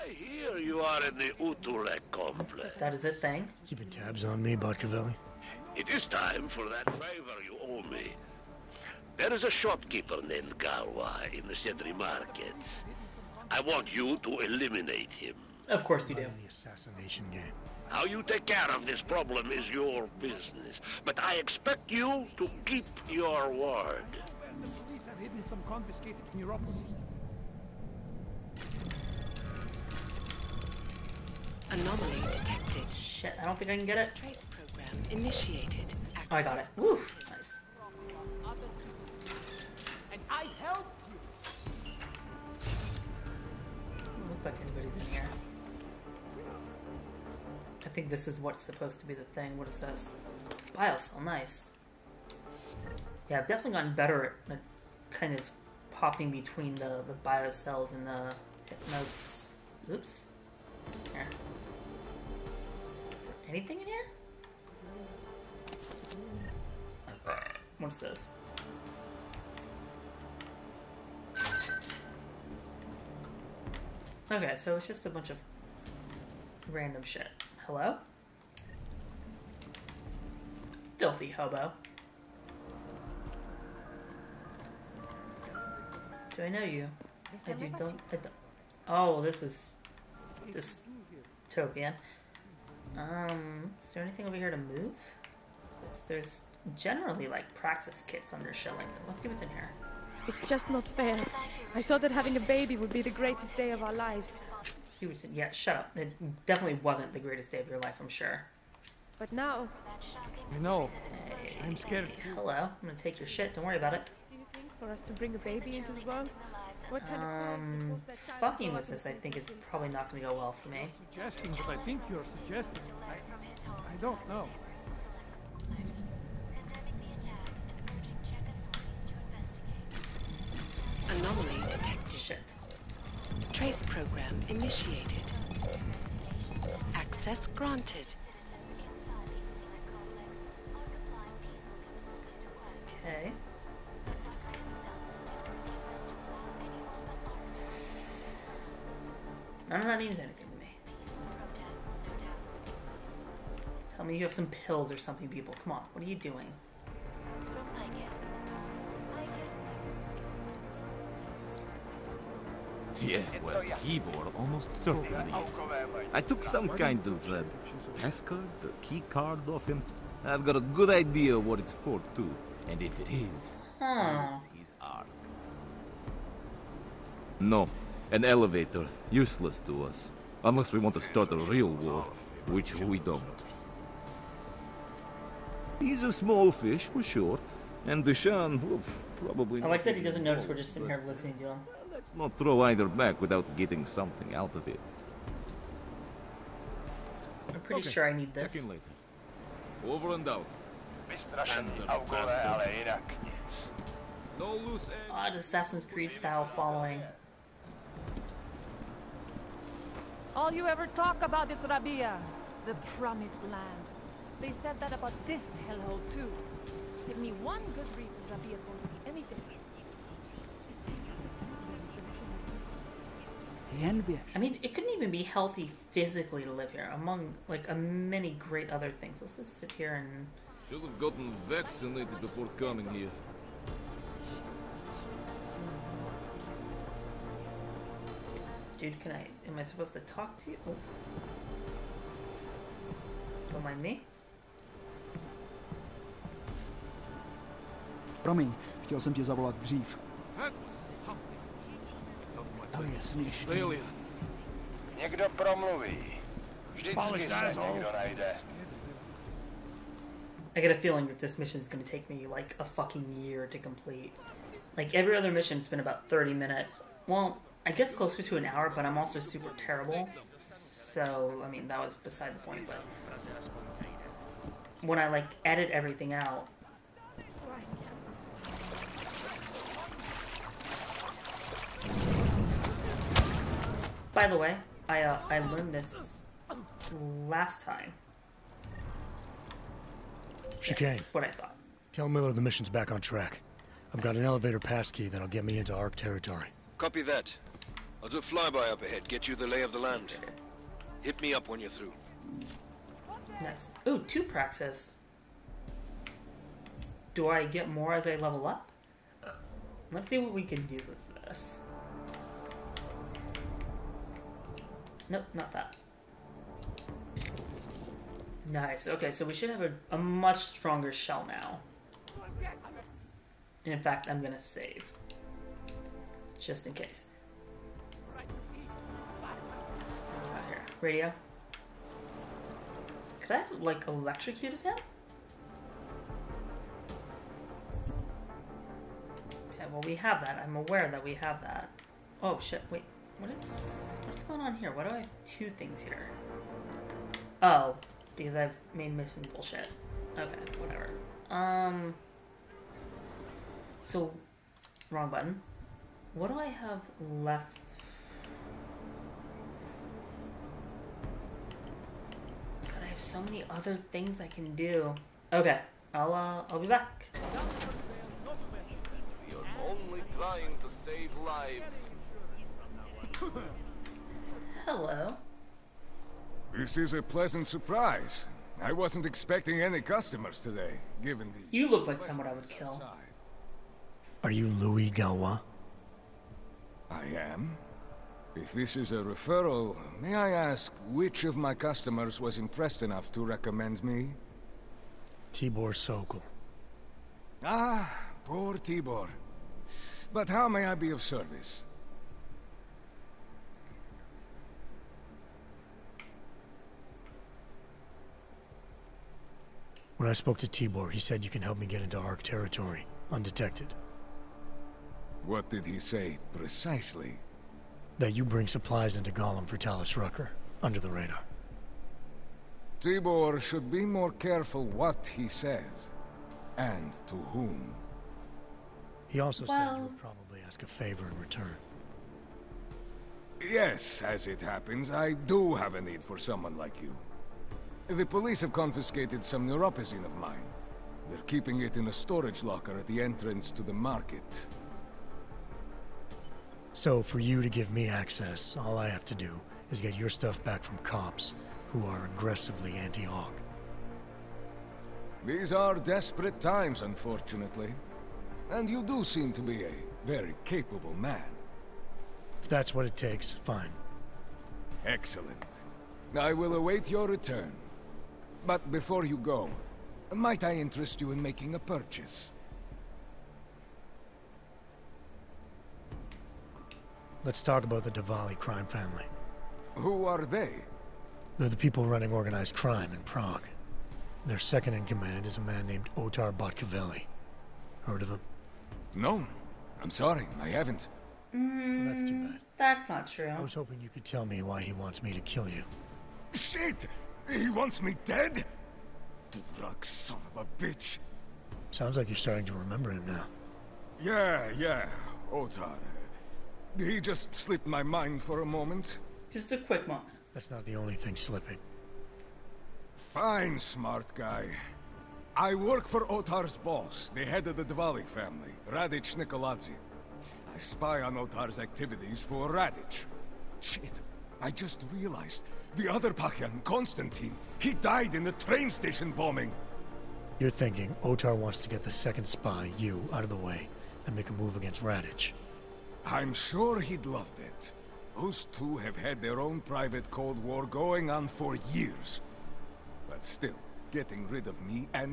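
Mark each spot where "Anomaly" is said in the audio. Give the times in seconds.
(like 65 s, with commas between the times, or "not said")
31 s, 131 s.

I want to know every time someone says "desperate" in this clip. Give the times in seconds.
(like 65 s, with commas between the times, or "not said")
455 s.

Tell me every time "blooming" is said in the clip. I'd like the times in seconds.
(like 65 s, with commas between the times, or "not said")
not said.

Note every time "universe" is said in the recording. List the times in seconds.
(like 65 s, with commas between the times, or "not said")
not said.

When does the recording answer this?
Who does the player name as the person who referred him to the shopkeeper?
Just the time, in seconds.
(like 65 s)
395 s.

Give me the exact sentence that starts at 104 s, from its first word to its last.
She would say, yeah, shut up.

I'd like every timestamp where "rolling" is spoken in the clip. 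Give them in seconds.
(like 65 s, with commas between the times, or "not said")
not said.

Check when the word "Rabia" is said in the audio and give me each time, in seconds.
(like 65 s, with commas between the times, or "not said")
211 s, 218 s.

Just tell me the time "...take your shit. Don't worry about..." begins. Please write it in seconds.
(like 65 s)
112 s.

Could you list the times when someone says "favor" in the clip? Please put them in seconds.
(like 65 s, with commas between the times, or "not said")
6 s, 430 s.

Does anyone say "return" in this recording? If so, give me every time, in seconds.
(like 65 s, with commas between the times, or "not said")
431 s, 467 s.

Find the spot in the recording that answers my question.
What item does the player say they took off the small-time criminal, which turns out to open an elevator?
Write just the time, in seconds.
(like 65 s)
167 s.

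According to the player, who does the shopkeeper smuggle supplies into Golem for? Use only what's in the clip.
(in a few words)
Talos Rucker.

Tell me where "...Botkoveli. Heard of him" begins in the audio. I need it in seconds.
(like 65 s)
486 s.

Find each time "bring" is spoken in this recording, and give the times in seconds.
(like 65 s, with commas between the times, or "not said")
115 s, 418 s.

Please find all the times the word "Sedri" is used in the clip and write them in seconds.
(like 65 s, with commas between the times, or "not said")
11 s.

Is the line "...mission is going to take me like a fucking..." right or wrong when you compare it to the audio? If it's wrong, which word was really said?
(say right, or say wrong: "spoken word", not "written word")
right.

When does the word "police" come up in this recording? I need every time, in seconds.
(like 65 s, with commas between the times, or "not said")
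24 s, 438 s.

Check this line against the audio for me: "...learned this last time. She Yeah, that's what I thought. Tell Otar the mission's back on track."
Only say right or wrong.
wrong.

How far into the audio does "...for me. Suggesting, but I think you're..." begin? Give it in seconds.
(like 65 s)
120 s.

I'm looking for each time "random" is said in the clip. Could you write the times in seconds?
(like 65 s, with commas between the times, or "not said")
76 s.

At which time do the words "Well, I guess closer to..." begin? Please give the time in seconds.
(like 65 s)
267 s.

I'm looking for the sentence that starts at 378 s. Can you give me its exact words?
I wasn't expecting any customers today, given the...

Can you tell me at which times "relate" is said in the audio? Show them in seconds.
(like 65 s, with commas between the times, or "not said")
not said.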